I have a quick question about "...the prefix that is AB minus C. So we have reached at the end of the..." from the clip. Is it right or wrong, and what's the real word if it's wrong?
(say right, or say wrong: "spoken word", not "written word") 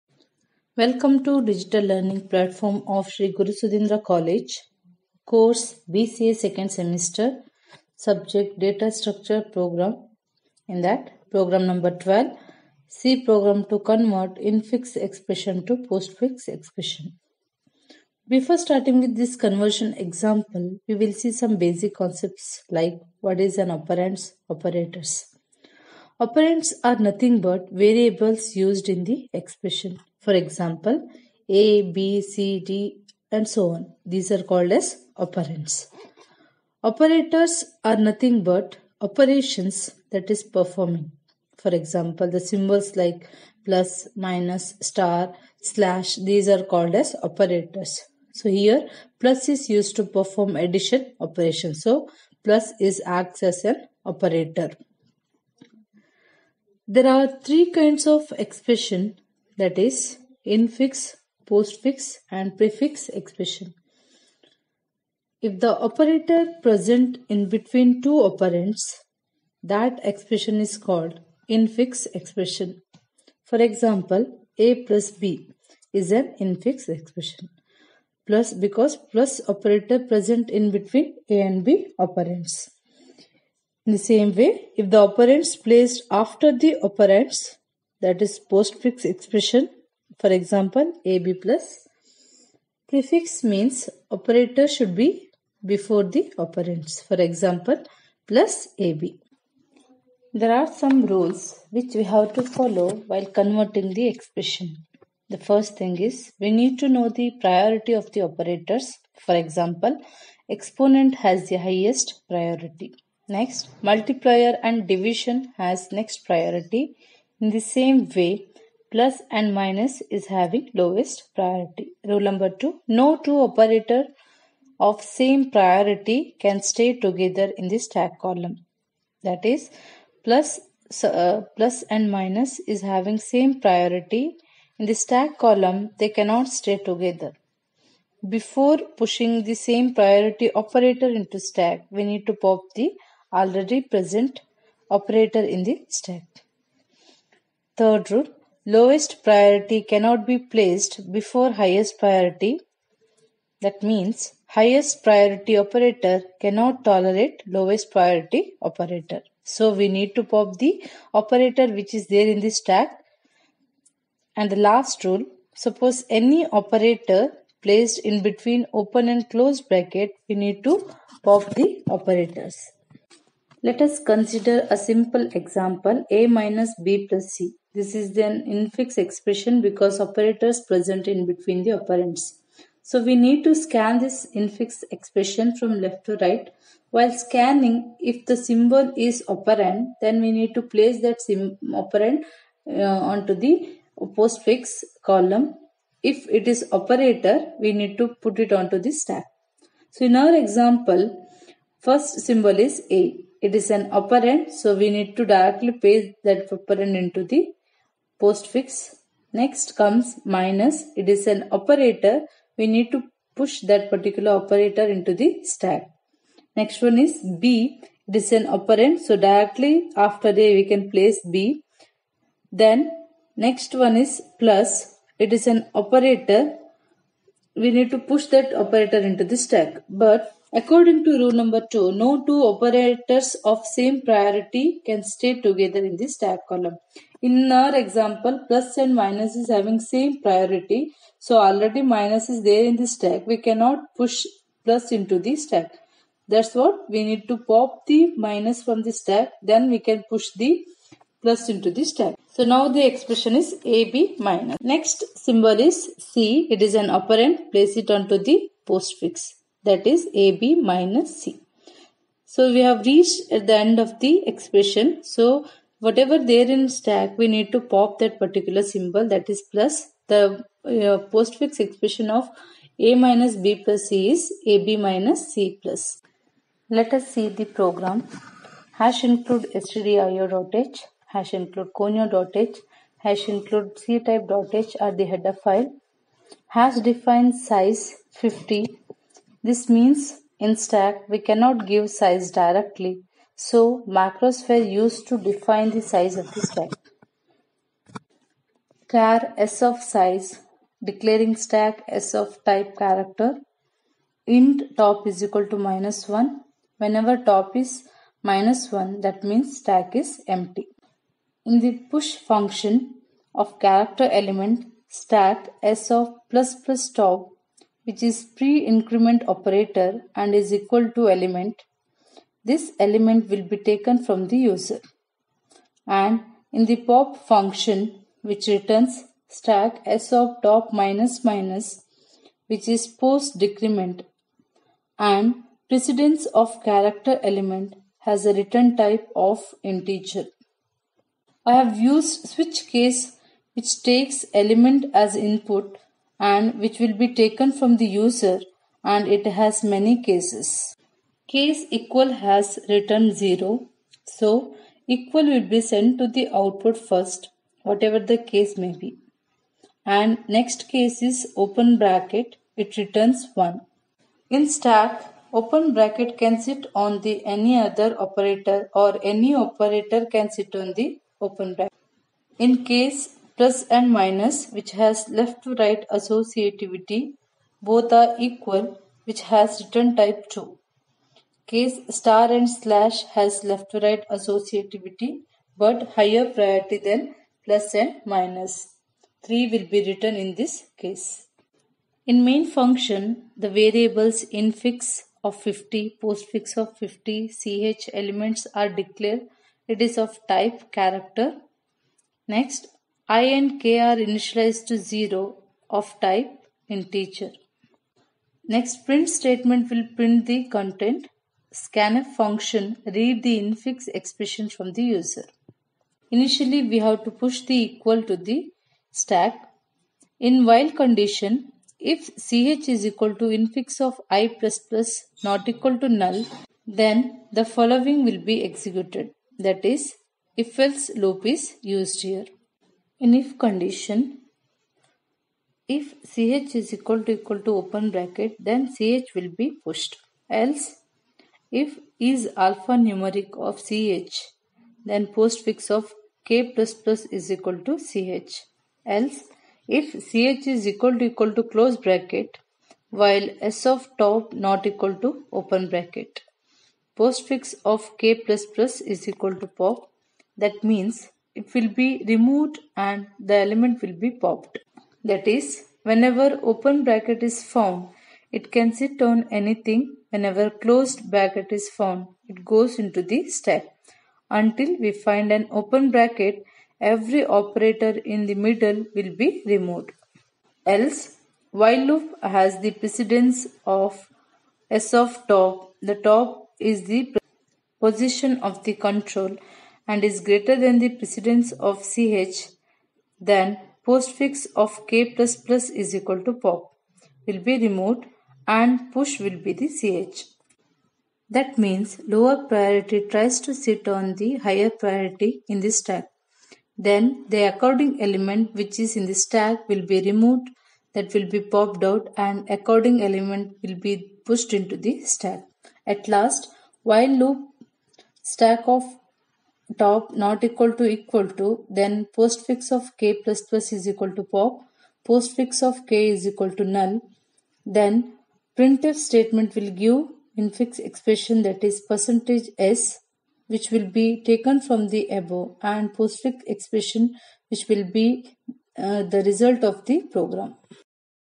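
wrong: "postfix", not "prefix".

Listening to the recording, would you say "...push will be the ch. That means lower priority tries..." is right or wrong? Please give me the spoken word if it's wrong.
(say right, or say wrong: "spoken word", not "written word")
right.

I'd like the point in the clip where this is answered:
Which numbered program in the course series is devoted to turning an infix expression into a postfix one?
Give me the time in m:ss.
0:11.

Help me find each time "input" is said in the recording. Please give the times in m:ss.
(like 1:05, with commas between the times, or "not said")
5:45.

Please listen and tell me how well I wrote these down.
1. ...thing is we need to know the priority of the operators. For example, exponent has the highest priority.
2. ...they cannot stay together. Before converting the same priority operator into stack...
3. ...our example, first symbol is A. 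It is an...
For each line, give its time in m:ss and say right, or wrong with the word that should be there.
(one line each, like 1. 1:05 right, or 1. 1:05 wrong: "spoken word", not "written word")
1. 1:45 right
2. 2:15 wrong: "pushing", not "converting"
3. 3:20 right.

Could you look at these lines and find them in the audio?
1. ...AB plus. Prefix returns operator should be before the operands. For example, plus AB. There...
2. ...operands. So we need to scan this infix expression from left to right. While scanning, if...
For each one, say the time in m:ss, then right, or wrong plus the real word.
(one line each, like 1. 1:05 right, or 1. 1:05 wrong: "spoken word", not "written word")
1. 1:31 wrong: "means", not "returns"
2. 3:01 right.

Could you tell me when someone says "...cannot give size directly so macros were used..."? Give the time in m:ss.
4:51.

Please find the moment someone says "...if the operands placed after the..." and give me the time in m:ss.
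1:24.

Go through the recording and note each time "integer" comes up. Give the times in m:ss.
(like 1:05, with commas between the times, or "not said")
5:39, 6:46.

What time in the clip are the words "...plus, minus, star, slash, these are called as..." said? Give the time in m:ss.
0:43.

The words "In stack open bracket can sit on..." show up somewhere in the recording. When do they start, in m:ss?
6:04.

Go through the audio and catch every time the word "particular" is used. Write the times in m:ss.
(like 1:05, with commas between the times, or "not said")
3:33, 4:28.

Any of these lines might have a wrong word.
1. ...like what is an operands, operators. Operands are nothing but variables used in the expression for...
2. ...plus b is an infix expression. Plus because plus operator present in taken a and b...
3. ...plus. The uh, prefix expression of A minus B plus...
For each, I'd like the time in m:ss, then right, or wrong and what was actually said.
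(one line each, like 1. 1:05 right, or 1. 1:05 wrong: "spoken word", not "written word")
1. 0:22 right
2. 1:14 wrong: "between", not "taken"
3. 4:29 wrong: "postfix", not "prefix".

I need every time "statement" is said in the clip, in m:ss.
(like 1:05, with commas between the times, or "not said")
6:49, 8:48.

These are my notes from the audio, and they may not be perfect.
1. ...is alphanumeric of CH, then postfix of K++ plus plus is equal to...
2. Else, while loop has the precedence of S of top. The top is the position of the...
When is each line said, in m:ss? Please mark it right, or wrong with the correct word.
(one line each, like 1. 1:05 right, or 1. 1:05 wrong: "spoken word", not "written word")
1. 7:21 right
2. 8:00 right.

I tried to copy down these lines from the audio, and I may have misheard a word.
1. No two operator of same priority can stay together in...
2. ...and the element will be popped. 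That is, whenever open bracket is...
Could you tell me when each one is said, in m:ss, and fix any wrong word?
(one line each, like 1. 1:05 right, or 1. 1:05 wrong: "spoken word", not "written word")
1. 2:02 right
2. 7:42 right.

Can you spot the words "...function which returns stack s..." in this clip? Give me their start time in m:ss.
5:27.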